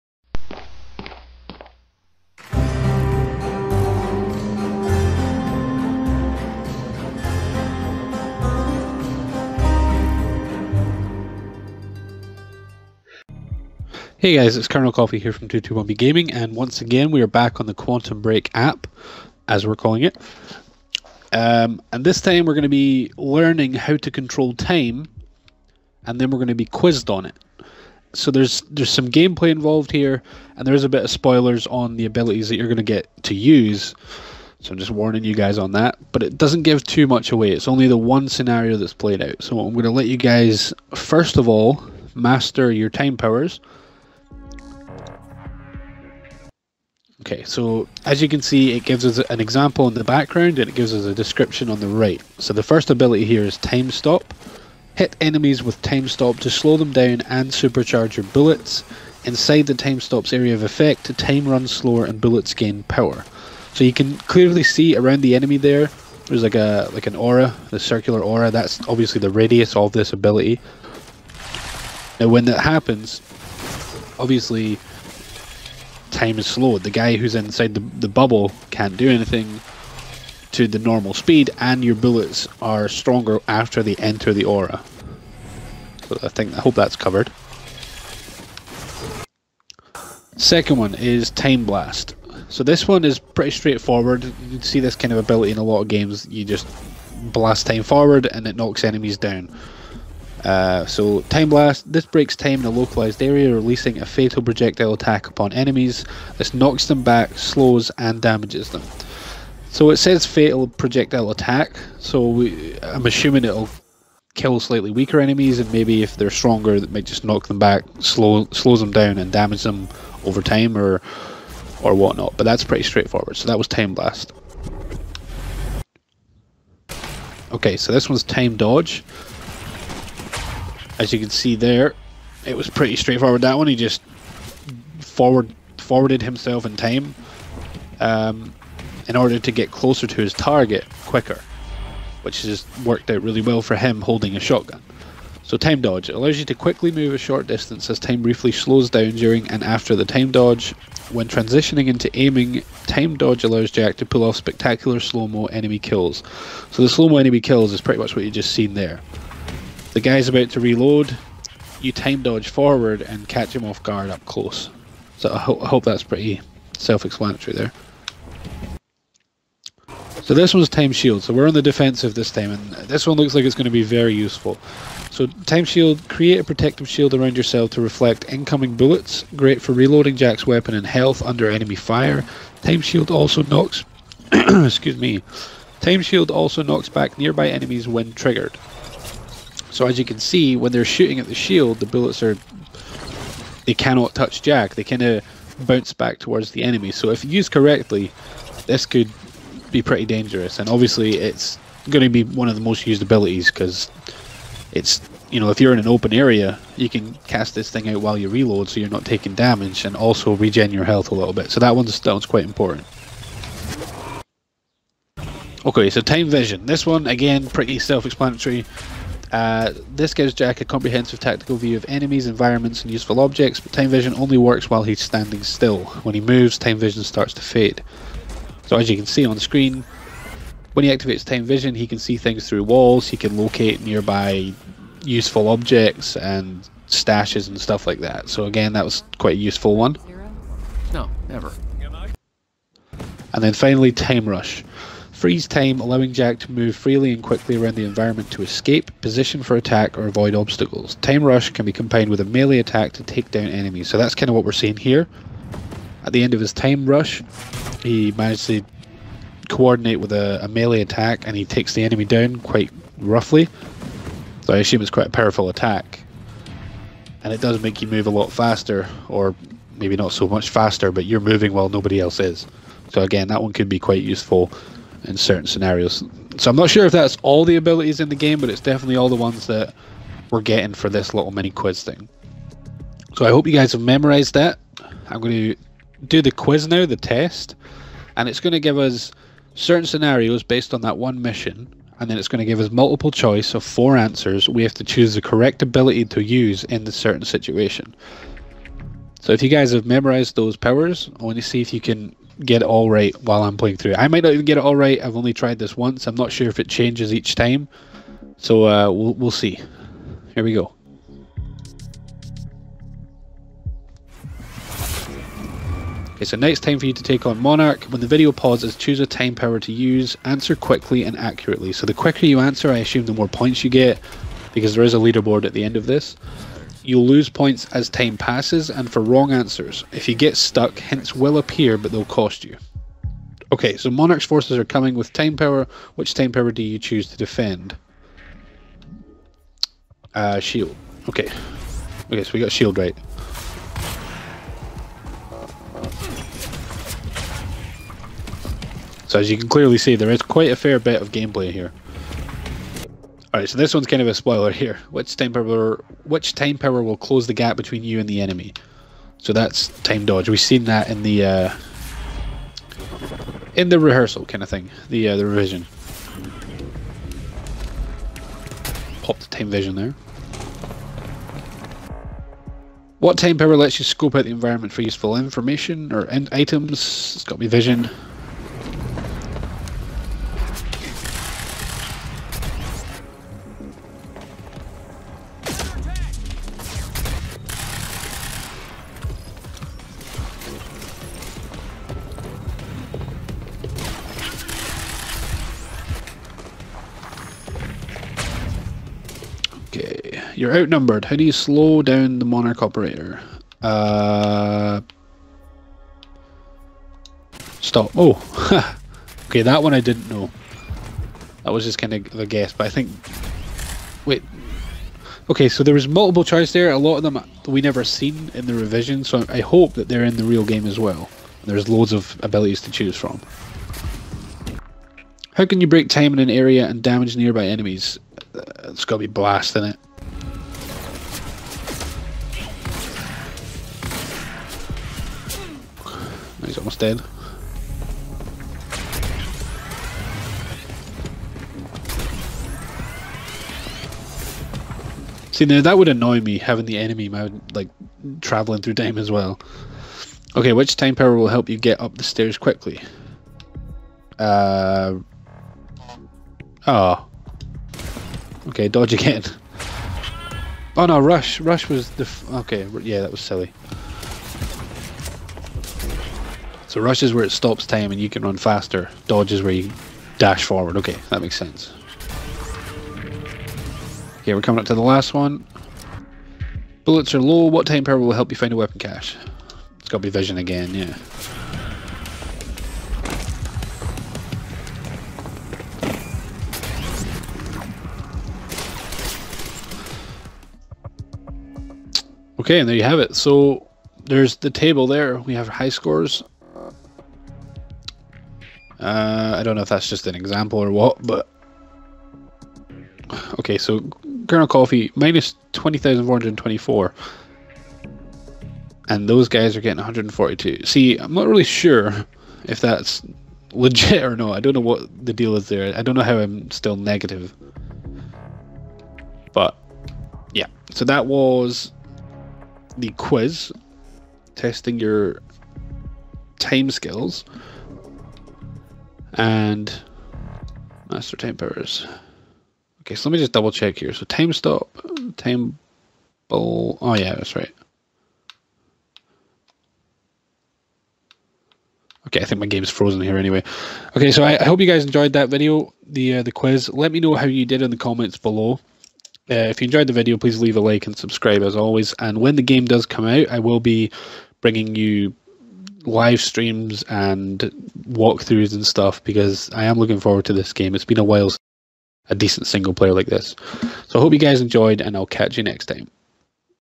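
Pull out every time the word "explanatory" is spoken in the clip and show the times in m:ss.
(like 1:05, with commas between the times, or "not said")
2:46, 3:37.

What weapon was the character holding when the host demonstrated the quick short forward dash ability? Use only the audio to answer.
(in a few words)
shotgun.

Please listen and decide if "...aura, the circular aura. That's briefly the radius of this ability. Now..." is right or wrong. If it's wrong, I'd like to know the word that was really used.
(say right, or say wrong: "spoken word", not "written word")
wrong: "obviously", not "briefly".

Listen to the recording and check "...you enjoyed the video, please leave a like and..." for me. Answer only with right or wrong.
right.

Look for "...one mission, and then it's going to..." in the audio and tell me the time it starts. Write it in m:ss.
4:50.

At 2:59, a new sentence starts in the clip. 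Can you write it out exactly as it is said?
Great for reloading Jack's weapon and health under enemy fire.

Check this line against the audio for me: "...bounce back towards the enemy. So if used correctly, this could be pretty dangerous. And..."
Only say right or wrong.
right.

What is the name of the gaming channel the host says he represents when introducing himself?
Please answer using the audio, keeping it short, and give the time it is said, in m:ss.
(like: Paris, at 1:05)
221B Gaming, at 0:15.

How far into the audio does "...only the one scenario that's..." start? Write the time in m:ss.
0:37.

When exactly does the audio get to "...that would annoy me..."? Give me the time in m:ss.
7:25.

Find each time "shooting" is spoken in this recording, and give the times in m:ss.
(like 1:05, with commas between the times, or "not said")
3:10.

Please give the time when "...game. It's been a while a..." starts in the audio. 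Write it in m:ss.
9:20.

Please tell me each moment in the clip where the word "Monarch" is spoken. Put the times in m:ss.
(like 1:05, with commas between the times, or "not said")
5:17, 5:33, 6:42.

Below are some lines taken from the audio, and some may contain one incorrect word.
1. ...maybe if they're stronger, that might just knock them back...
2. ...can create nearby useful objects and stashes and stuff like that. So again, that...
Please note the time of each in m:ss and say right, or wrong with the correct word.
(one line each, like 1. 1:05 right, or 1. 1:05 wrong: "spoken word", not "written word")
1. 1:55 right
2. 3:53 wrong: "locate", not "create".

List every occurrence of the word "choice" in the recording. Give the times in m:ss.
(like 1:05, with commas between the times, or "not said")
4:53, 6:56.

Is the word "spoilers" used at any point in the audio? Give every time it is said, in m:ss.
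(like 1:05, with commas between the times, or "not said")
0:31, 5:54.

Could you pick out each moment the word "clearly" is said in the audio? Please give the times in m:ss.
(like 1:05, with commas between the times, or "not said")
1:04, 5:49.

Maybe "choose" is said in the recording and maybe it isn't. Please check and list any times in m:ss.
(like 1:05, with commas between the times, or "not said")
4:54, 5:18, 5:36, 7:02.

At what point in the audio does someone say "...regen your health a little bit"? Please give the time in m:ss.
3:30.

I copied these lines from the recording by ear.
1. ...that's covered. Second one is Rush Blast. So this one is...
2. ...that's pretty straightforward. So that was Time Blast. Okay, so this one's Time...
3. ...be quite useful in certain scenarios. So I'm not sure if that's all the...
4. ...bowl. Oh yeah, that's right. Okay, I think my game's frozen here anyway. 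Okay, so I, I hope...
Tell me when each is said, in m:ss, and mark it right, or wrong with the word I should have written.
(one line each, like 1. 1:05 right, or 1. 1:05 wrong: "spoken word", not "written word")
1. 1:26 wrong: "Time", not "Rush"
2. 2:02 right
3. 4:33 right
4. 8:56 right.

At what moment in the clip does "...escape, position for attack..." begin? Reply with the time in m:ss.
4:08.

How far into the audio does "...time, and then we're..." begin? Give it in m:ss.
0:24.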